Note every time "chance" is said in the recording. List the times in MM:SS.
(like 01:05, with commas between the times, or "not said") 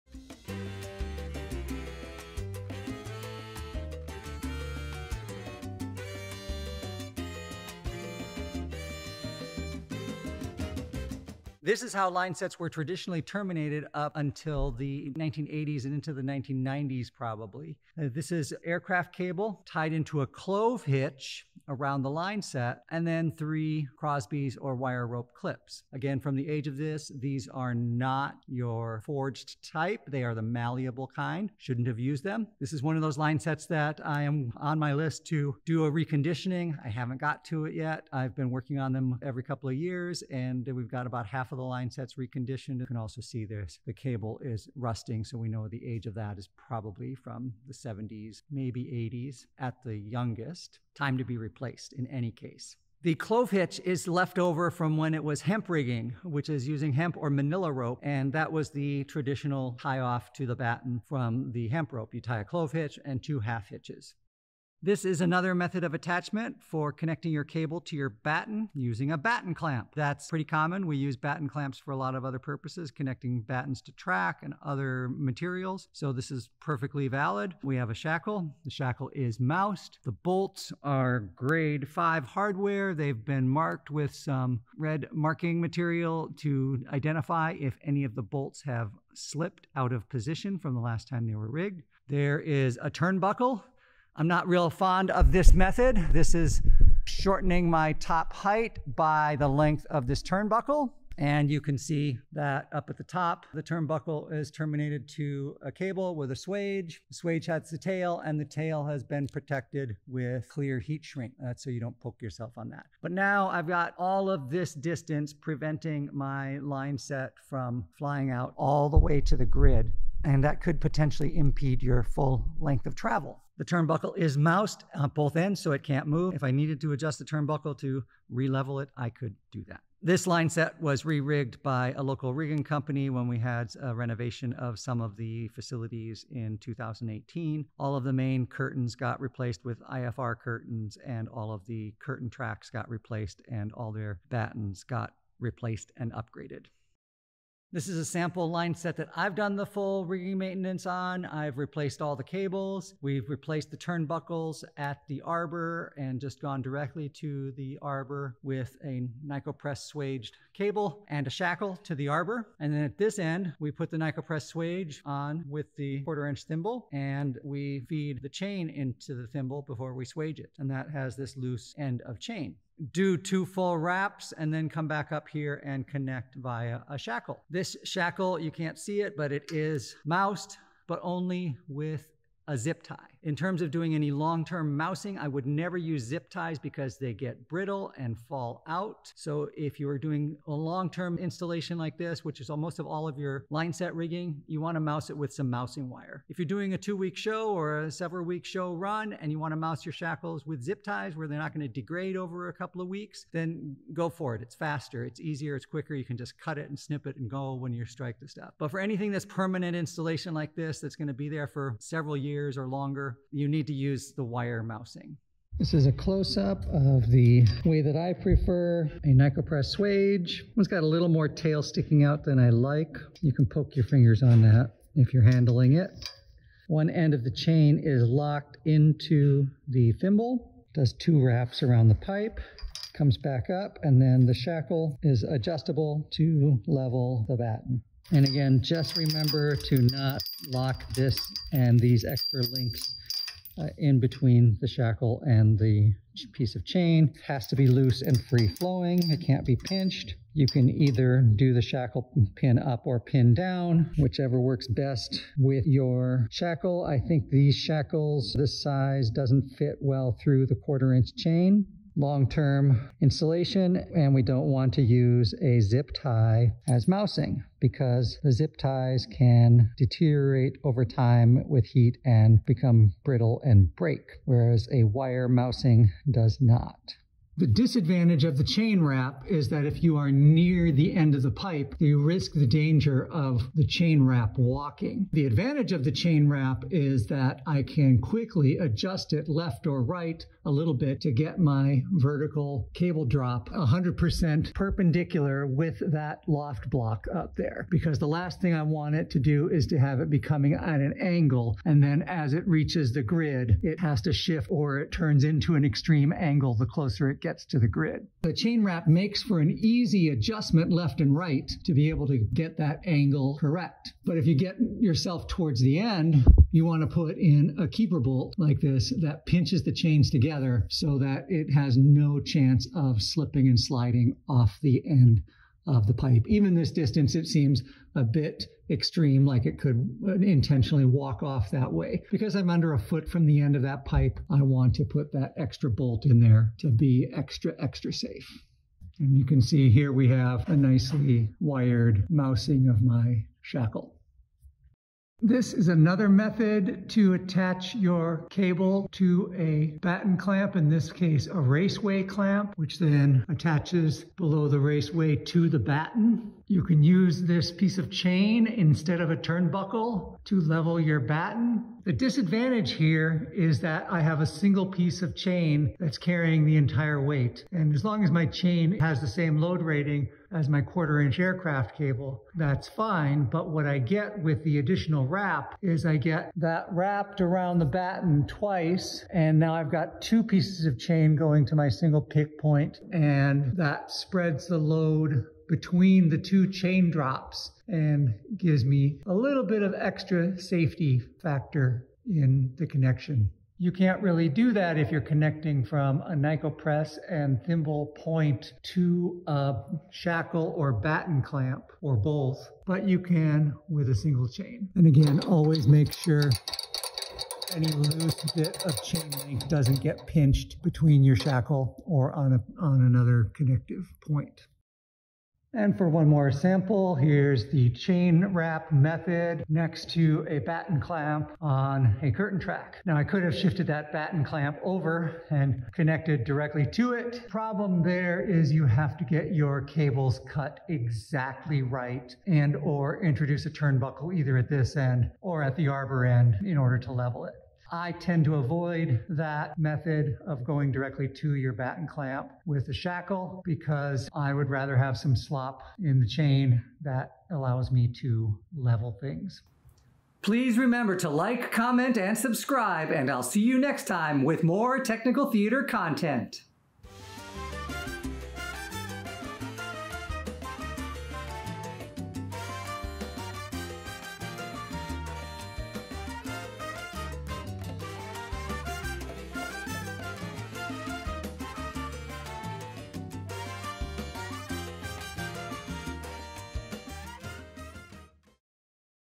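05:22.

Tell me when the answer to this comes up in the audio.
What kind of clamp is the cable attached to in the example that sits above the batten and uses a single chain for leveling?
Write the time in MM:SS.
05:51.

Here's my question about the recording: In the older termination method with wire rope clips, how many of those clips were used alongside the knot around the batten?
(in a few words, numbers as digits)
3.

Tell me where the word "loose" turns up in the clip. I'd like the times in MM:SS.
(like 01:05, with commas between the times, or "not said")
02:51, 04:07, 06:47.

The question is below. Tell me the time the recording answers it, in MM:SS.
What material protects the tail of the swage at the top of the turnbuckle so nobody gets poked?
01:50.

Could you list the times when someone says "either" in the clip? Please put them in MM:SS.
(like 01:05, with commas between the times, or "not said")
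04:10, 07:14.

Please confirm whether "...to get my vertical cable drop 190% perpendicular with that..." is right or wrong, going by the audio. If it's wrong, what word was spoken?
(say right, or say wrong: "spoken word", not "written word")
wrong: "100", not "190".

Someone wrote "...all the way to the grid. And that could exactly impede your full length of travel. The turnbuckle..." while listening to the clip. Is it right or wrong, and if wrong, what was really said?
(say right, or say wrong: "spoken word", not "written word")
wrong: "potentially", not "exactly".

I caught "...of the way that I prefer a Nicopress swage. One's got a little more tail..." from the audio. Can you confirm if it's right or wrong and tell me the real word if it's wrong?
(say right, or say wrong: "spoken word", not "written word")
right.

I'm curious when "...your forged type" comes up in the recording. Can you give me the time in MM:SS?
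00:28.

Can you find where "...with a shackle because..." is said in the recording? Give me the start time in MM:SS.
07:22.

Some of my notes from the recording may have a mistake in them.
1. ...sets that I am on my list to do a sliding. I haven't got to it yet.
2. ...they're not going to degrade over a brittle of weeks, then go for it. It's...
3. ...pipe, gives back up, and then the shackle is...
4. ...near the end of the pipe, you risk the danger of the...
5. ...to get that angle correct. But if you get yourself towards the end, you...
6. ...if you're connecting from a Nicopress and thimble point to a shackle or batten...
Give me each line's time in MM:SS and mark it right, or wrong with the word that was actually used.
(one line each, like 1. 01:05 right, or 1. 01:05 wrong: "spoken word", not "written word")
1. 00:33 wrong: "reconditioning", not "sliding"
2. 03:21 wrong: "couple", not "brittle"
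3. 03:52 wrong: "comes", not "gives"
4. 04:40 right
5. 05:12 right
6. 06:34 right.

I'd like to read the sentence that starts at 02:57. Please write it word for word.
This shackle, you can't see it, but it is moused, but only with a zip tie.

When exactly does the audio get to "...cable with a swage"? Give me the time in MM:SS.
01:45.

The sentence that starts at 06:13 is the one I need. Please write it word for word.
But what I get with the additional wrap is I get that wrapped around the batten twice.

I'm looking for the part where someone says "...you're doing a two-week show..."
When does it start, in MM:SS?
03:16.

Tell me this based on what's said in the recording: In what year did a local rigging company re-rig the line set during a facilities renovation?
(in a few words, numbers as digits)
2018.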